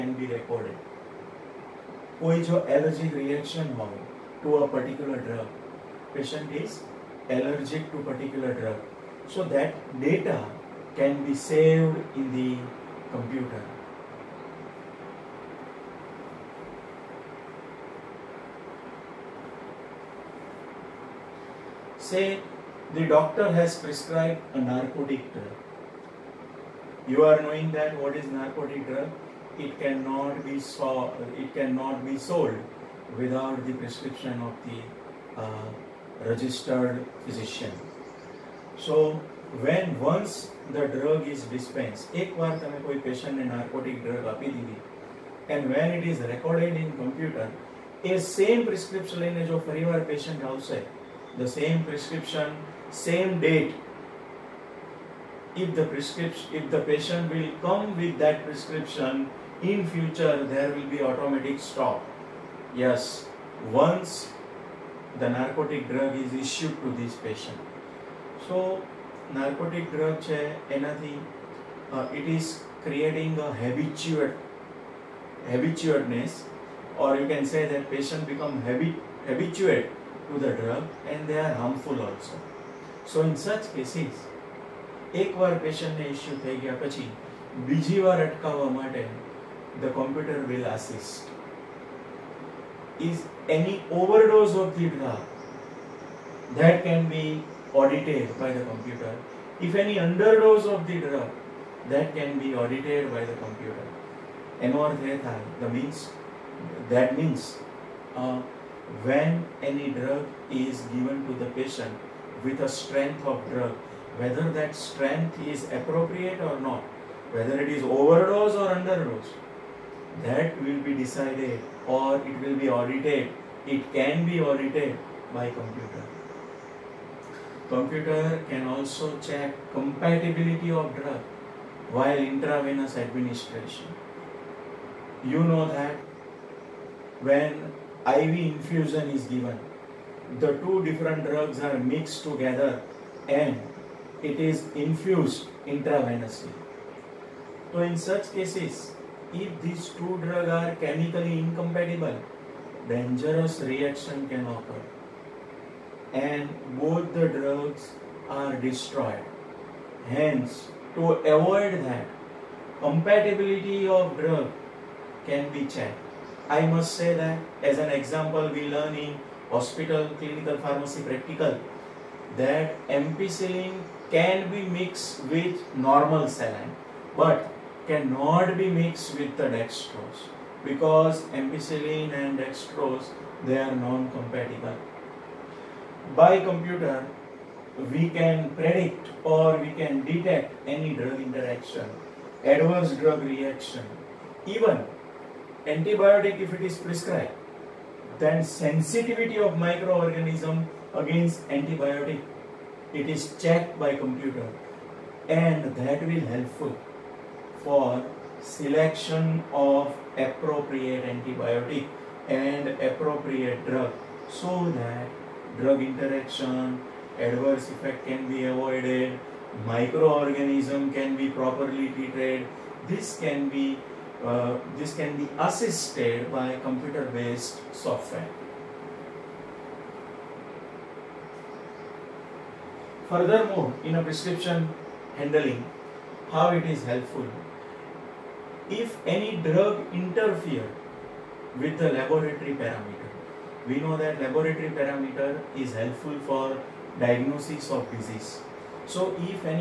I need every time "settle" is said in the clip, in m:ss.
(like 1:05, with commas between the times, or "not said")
not said.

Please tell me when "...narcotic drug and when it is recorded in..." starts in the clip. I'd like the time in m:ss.
0:43.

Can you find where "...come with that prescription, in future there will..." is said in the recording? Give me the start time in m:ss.
0:57.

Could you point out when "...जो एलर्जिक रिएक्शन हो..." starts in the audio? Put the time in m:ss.
0:02.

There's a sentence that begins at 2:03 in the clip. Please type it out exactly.
It can be audited by computer.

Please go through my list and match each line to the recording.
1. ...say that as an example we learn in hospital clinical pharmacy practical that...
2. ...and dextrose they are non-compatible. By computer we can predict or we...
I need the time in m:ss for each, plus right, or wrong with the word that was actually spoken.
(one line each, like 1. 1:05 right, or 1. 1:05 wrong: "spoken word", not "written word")
1. 2:46 right
2. 3:02 right.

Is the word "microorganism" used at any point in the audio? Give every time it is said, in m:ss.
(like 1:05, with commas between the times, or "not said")
3:19, 3:39.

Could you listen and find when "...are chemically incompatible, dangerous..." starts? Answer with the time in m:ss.
2:30.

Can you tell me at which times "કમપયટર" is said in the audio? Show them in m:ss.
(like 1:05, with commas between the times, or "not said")
1:29, 1:38, 1:43.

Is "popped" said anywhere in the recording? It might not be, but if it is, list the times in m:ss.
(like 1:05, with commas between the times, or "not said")
not said.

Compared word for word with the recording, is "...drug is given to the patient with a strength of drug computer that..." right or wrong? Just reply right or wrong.
wrong.